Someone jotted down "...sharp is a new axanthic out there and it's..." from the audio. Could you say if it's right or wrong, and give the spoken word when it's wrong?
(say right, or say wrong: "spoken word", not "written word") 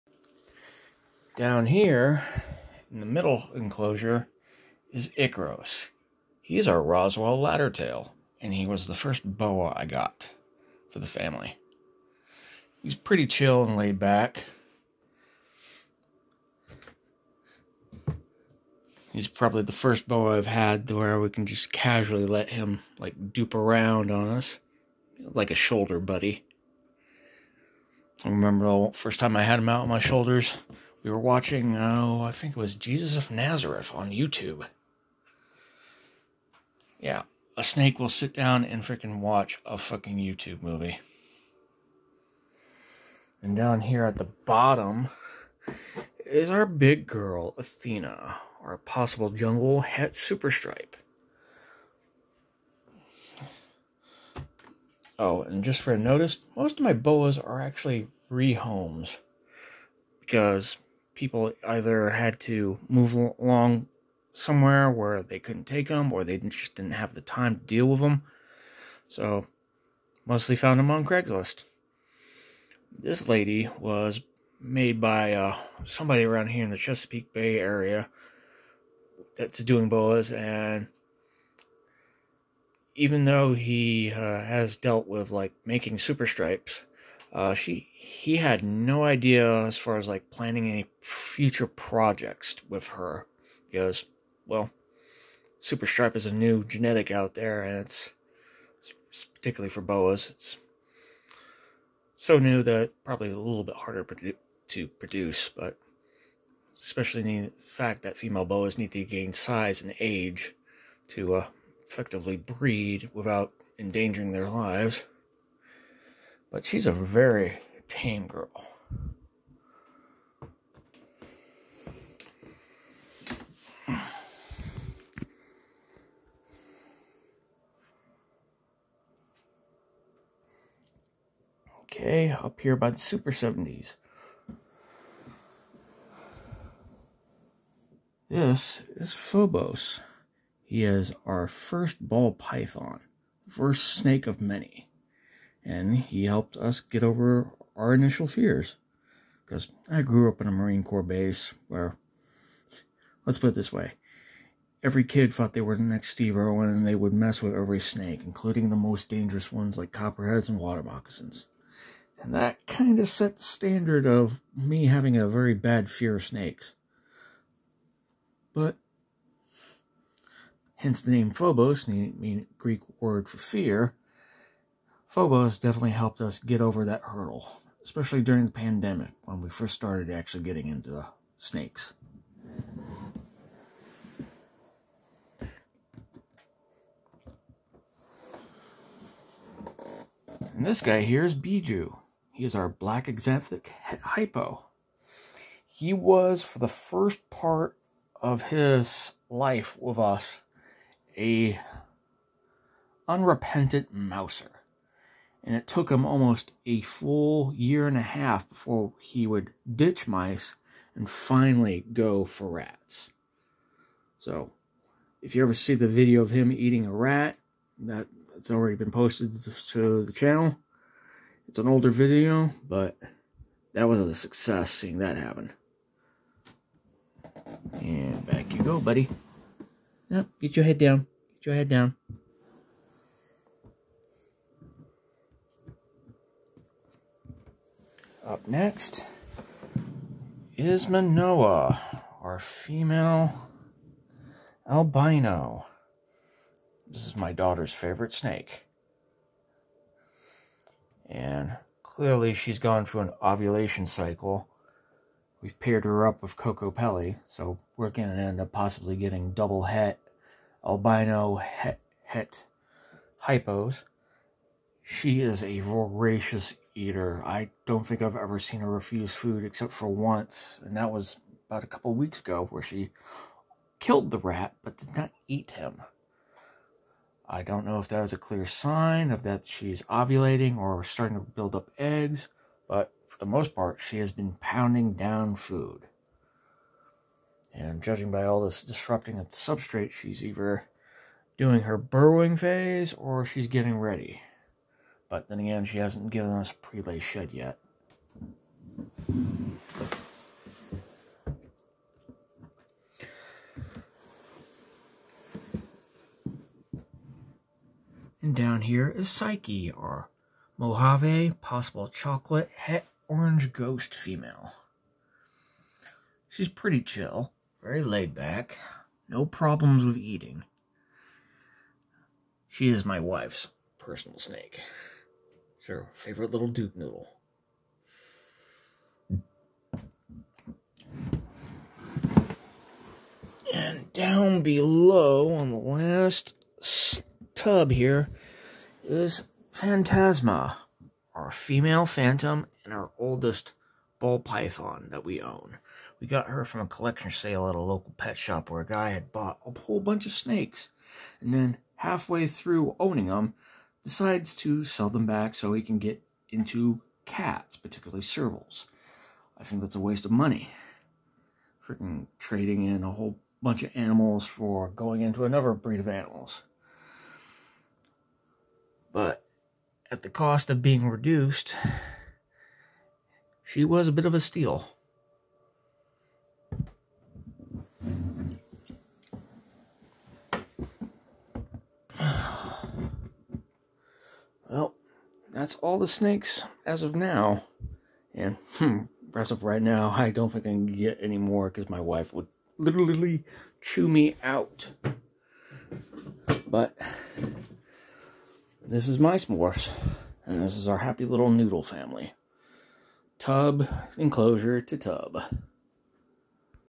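wrong: "genetic", not "axanthic".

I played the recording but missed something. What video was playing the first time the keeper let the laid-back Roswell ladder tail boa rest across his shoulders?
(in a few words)
Jesus of Nazareth.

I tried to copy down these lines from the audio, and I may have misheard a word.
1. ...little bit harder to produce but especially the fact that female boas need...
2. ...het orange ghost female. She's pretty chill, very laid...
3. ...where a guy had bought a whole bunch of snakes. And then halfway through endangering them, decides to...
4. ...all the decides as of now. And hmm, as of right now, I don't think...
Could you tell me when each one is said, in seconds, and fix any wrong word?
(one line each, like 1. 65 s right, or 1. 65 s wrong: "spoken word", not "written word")
1. 103 s right
2. 312 s right
3. 348 s wrong: "owning", not "endangering"
4. 385 s wrong: "snakes", not "decides".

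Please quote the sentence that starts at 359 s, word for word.
I think that's a waste of money.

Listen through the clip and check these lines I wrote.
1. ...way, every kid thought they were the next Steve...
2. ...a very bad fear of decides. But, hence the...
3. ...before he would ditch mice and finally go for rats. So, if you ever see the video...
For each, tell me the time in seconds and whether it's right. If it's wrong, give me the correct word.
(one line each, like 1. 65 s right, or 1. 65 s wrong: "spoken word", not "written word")
1. 153 s right
2. 165 s wrong: "snakes", not "decides"
3. 208 s right.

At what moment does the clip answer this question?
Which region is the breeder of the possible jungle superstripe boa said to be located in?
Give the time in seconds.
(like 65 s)
76 s.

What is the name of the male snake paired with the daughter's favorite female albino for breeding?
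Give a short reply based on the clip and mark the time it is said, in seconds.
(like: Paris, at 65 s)
Kokopelli, at 256 s.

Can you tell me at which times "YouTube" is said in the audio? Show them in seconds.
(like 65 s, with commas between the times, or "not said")
34 s, 40 s.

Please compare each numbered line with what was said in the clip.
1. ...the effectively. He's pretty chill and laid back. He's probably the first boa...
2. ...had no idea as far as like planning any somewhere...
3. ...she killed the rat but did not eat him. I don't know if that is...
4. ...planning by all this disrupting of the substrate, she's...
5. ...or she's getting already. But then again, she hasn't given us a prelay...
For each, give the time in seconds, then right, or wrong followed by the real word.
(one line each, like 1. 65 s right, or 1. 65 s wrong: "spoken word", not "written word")
1. 10 s wrong: "family", not "effectively"
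2. 88 s wrong: "future", not "somewhere"
3. 272 s right
4. 287 s wrong: "judging", not "planning"
5. 292 s wrong: "ready", not "already".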